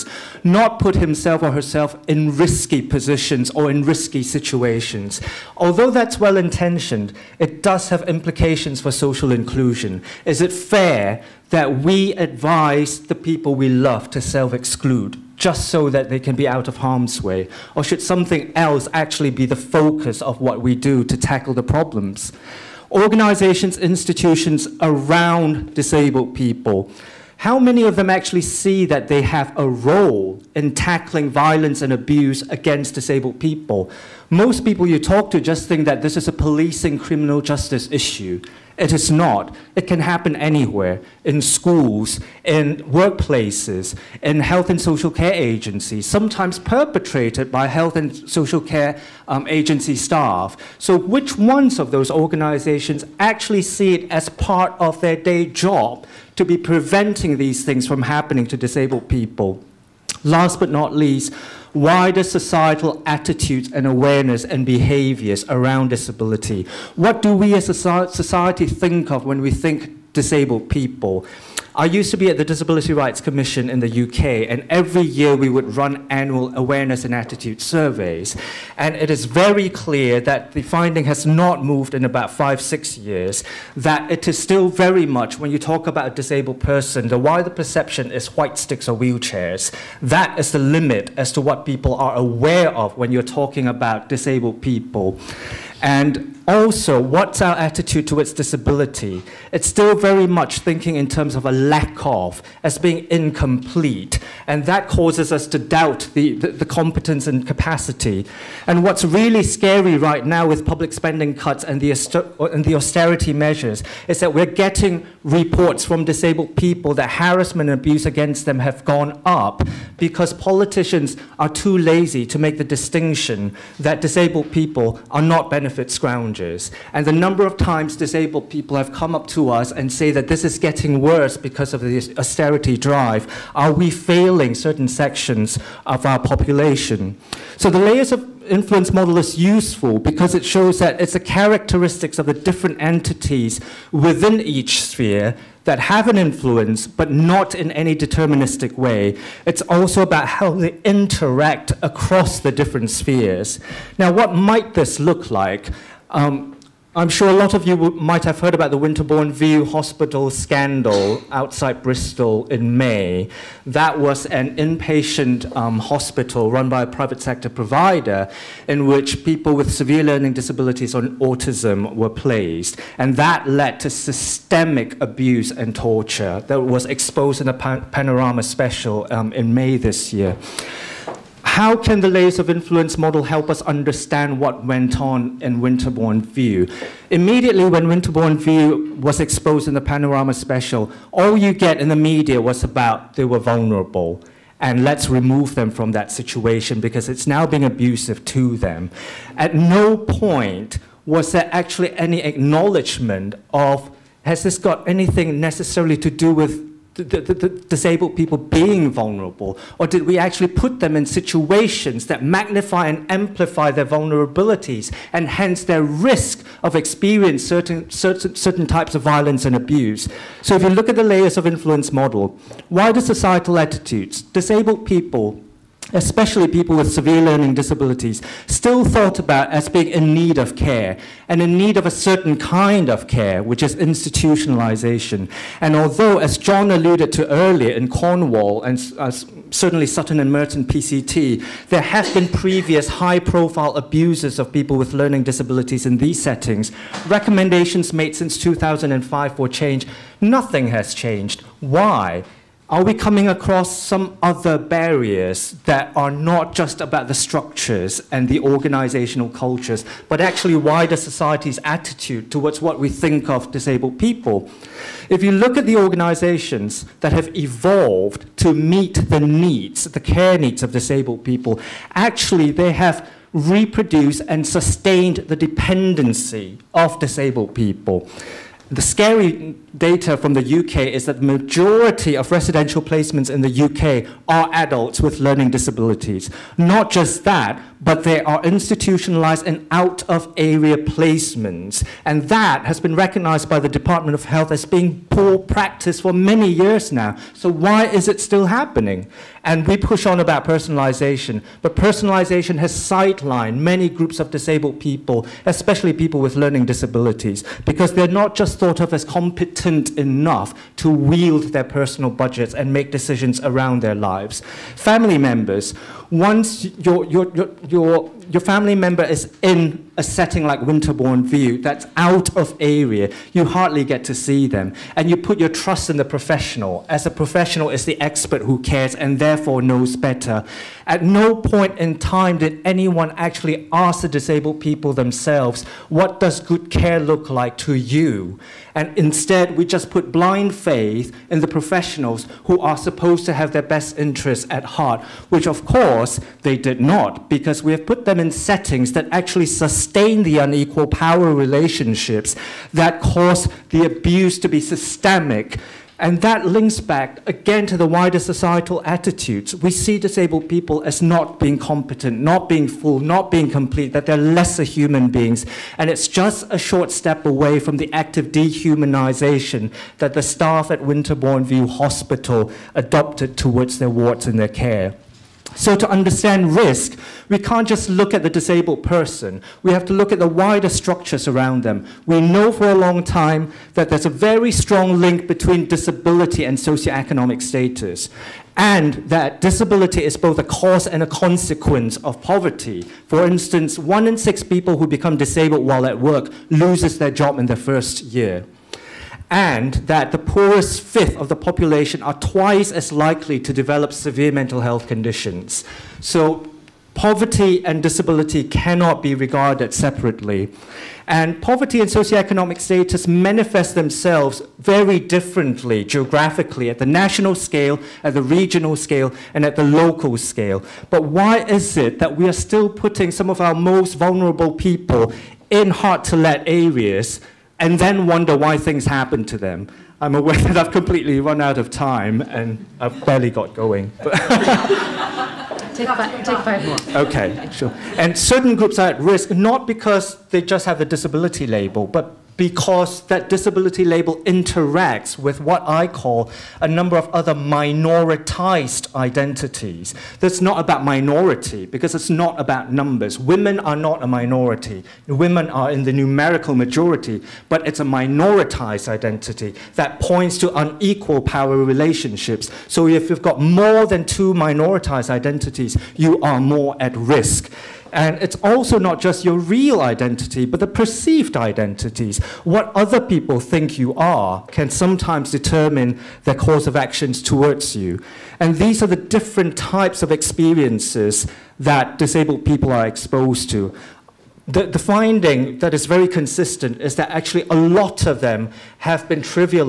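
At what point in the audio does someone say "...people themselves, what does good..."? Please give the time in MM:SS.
05:34.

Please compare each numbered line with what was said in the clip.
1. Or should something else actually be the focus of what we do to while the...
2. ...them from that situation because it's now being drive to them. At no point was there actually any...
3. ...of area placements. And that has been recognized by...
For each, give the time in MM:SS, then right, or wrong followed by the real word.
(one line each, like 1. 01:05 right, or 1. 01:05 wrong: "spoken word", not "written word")
1. 00:17 wrong: "tackle", not "while"
2. 03:15 wrong: "abusive", not "drive"
3. 04:50 right.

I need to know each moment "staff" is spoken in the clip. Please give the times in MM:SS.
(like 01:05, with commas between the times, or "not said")
00:49, 06:10.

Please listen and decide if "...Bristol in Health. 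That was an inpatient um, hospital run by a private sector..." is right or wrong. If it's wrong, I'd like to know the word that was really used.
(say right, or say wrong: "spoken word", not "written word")
wrong: "May", not "Health".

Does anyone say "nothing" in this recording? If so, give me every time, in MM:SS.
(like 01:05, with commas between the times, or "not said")
04:10.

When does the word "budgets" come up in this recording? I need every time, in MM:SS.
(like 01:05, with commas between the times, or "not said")
05:12.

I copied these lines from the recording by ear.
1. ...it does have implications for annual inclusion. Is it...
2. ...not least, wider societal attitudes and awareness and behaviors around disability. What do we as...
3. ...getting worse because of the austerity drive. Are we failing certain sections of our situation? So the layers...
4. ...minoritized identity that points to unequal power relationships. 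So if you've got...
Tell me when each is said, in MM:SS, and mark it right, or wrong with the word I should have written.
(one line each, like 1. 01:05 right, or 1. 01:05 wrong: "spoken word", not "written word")
1. 00:07 wrong: "social", not "annual"
2. 01:00 right
3. 02:10 wrong: "population", not "situation"
4. 07:37 right.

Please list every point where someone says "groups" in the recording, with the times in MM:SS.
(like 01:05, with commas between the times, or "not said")
05:03, 07:18.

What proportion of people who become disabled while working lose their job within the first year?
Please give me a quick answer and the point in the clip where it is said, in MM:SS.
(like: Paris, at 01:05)
1 in 6, at 06:33.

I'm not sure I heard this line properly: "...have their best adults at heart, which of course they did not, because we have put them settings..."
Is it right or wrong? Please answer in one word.
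wrong.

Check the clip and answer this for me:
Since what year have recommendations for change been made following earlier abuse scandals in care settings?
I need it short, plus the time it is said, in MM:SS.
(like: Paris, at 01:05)
2005, at 04:08.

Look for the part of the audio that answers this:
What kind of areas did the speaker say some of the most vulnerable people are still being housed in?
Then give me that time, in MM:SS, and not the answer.
07:05.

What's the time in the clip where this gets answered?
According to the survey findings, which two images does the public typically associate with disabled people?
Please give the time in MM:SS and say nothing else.
01:28.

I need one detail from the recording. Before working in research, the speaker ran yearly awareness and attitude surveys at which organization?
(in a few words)
Disability Rights Commission.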